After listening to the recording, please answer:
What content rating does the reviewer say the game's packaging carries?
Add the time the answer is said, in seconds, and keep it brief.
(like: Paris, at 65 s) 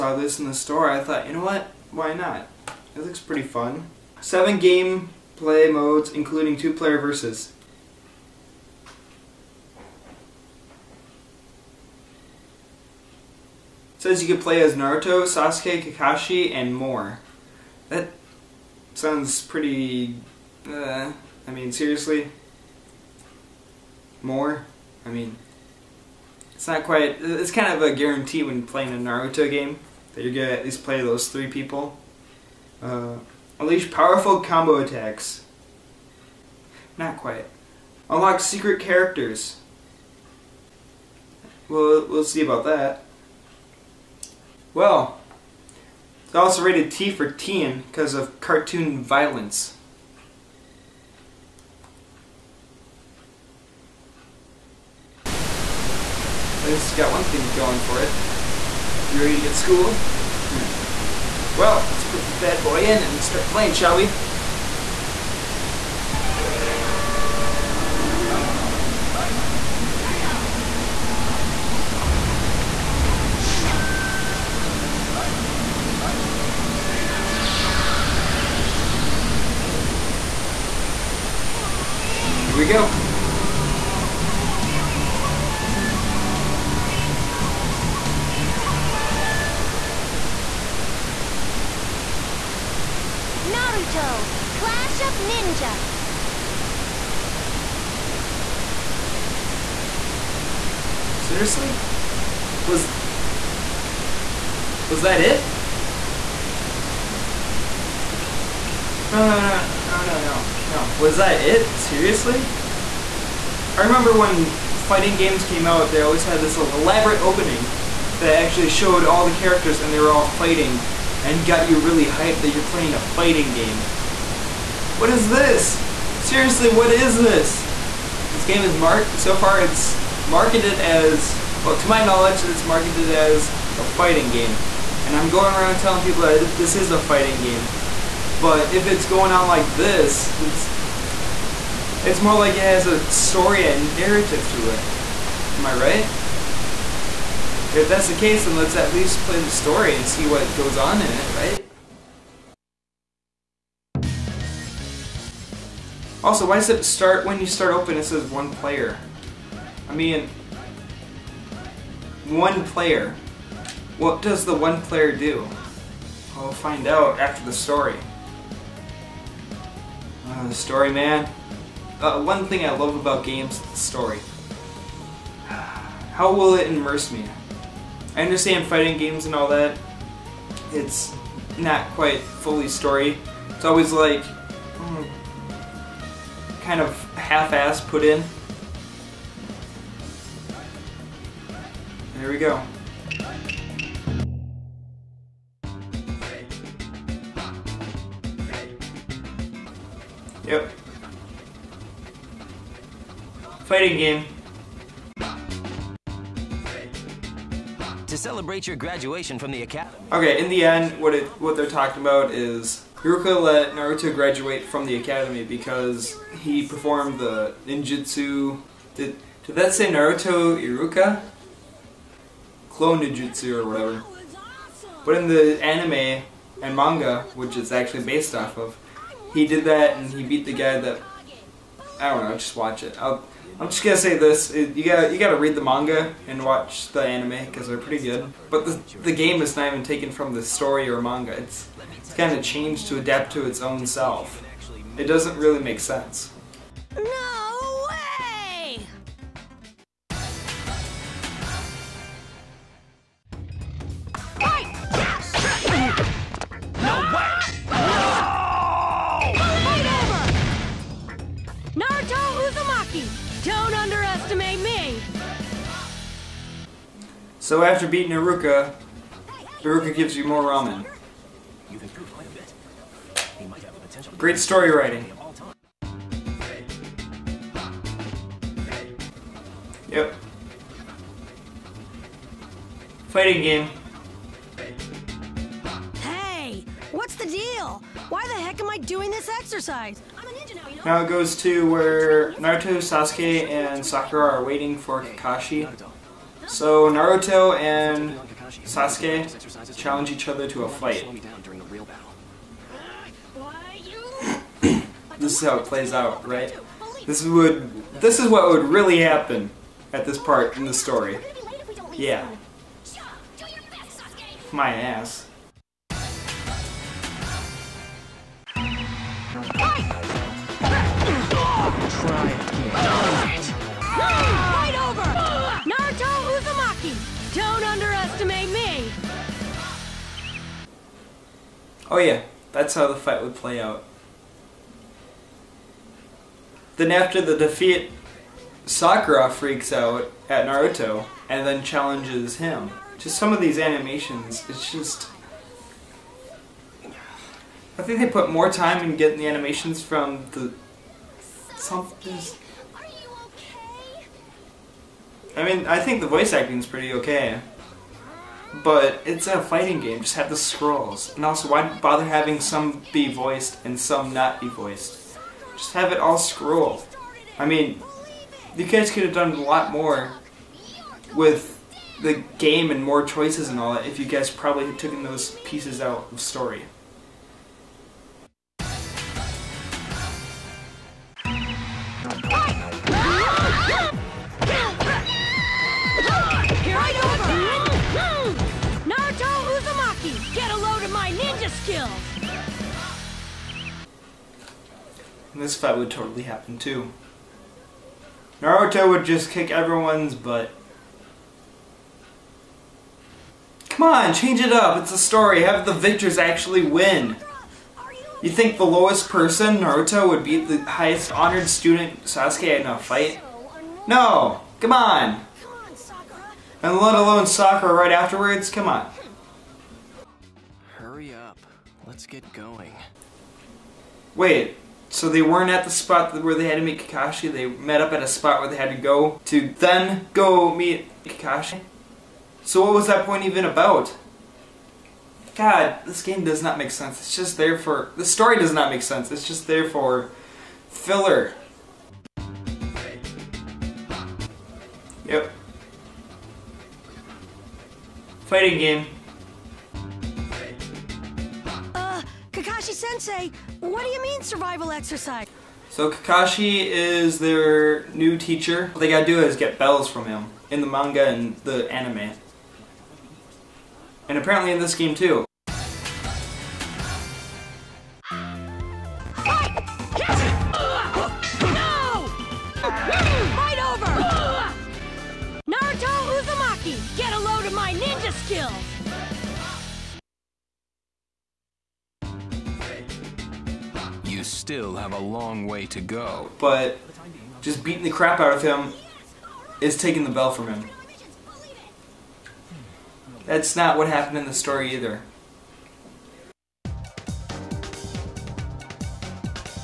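T for teen, at 46 s.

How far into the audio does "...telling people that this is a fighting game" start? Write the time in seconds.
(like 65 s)
135 s.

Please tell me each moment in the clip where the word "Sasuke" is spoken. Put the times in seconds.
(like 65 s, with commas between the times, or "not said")
15 s, 292 s, 298 s, 412 s.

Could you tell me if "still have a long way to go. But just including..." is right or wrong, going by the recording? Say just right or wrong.
wrong.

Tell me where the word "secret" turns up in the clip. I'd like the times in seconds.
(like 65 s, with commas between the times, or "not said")
38 s.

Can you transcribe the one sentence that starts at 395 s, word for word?
This fight would totally happen too.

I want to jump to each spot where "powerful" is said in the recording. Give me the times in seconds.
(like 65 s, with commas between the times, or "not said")
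33 s.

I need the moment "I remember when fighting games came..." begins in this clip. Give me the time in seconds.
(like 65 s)
113 s.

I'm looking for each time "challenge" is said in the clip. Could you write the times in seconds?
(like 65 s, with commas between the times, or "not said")
299 s, 341 s.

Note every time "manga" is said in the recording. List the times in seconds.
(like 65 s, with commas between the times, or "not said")
226 s, 235 s, 241 s, 460 s.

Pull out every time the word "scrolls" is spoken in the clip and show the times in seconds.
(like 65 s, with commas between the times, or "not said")
360 s, 366 s.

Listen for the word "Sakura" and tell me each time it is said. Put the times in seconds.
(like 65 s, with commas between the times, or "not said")
293 s, 338 s, 417 s.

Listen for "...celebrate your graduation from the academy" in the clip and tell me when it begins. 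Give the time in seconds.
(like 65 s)
208 s.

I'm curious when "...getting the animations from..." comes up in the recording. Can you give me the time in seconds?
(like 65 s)
348 s.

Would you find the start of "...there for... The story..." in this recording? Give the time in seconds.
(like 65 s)
437 s.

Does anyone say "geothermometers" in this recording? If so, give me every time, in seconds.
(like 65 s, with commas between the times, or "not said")
not said.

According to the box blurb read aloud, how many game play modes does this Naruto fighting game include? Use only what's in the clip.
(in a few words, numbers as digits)
7.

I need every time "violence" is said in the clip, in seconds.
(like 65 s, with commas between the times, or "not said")
49 s.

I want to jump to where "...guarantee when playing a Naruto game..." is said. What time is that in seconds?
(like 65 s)
27 s.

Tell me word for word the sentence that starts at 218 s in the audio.
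Did did that say Naruto Iruka?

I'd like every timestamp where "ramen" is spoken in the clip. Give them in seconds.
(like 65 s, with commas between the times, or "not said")
270 s.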